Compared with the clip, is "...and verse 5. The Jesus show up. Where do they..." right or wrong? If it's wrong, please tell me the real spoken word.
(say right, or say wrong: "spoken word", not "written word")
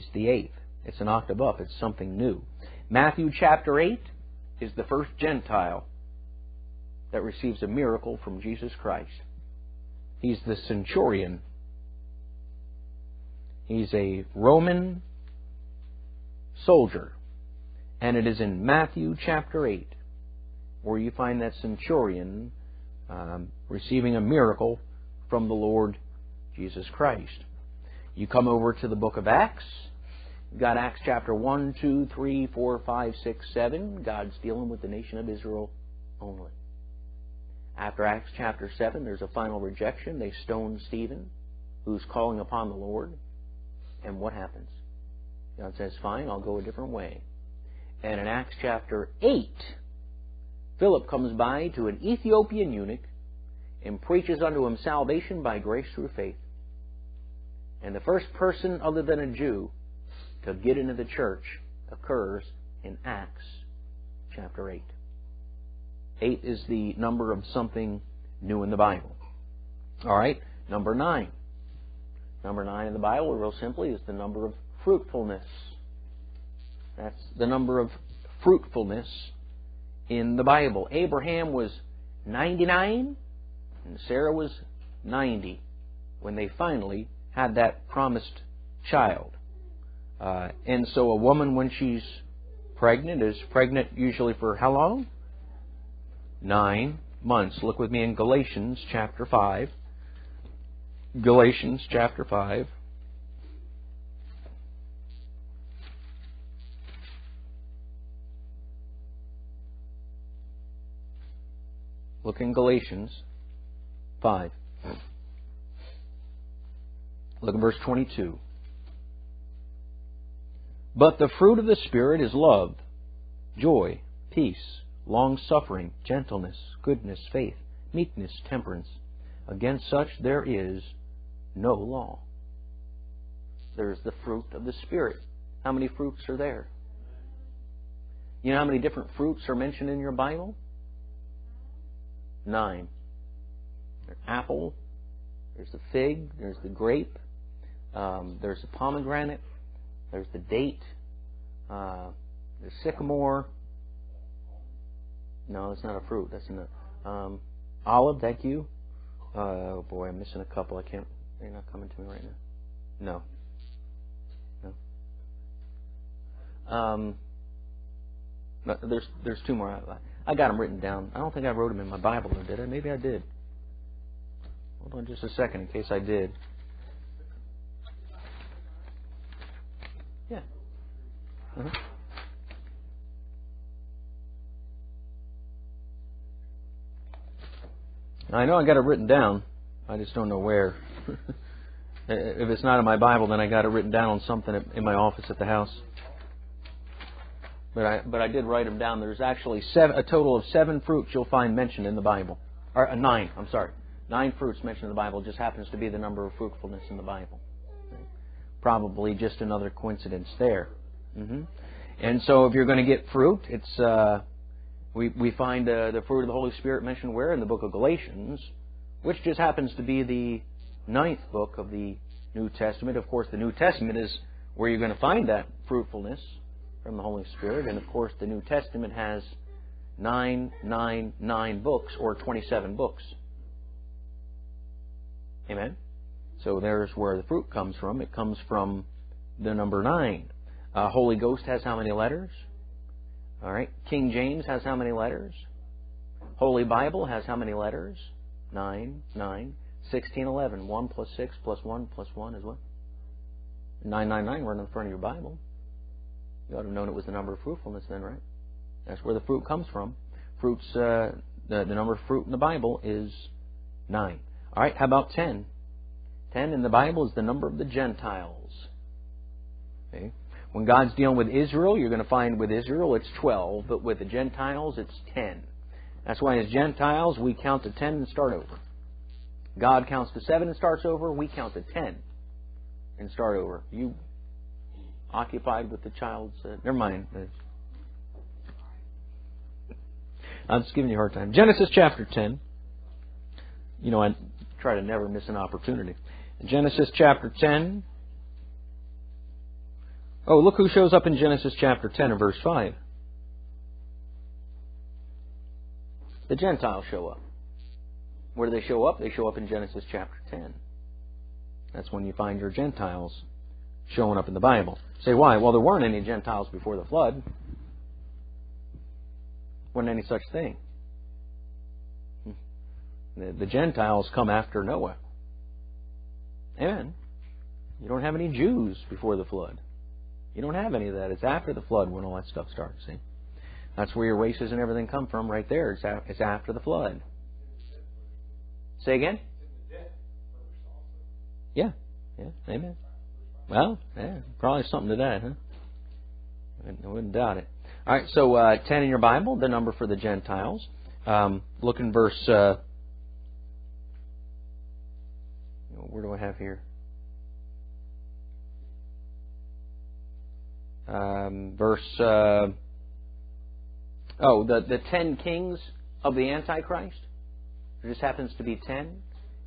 wrong: "Gentiles", not "Jesus".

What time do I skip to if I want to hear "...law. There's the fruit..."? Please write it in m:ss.
2:11.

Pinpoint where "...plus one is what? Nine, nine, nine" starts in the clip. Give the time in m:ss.
4:11.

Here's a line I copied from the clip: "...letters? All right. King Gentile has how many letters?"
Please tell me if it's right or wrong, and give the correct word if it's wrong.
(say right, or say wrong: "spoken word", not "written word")
wrong: "James", not "Gentile".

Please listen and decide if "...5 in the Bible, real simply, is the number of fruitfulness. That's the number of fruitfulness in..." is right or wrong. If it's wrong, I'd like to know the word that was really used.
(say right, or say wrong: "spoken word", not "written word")
wrong: "9", not "5".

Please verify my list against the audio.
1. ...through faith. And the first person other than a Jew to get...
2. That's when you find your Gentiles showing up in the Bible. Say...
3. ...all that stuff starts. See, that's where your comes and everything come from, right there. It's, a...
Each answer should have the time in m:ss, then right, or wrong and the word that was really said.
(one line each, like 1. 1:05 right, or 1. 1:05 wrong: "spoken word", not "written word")
1. 0:55 right
2. 5:11 right
3. 5:32 wrong: "races", not "comes".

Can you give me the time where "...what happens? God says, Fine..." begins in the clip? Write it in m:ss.
0:44.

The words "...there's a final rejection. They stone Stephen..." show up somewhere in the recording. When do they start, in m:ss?
0:39.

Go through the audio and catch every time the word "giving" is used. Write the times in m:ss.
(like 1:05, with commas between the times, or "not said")
4:50.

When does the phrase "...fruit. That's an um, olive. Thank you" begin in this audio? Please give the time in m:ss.
2:36.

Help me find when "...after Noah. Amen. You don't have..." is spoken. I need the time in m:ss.
5:24.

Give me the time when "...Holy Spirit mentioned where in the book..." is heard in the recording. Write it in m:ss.
3:36.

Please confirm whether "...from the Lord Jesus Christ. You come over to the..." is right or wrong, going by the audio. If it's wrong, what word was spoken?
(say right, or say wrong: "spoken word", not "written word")
right.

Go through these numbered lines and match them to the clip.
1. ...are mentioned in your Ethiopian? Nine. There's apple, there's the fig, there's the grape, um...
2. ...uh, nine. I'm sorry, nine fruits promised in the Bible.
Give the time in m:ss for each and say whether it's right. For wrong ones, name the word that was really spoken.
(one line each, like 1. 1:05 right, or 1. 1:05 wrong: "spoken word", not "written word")
1. 2:19 wrong: "Bible", not "Ethiopian"
2. 3:22 wrong: "mentioned", not "promised".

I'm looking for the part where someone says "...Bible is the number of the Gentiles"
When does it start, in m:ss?
4:26.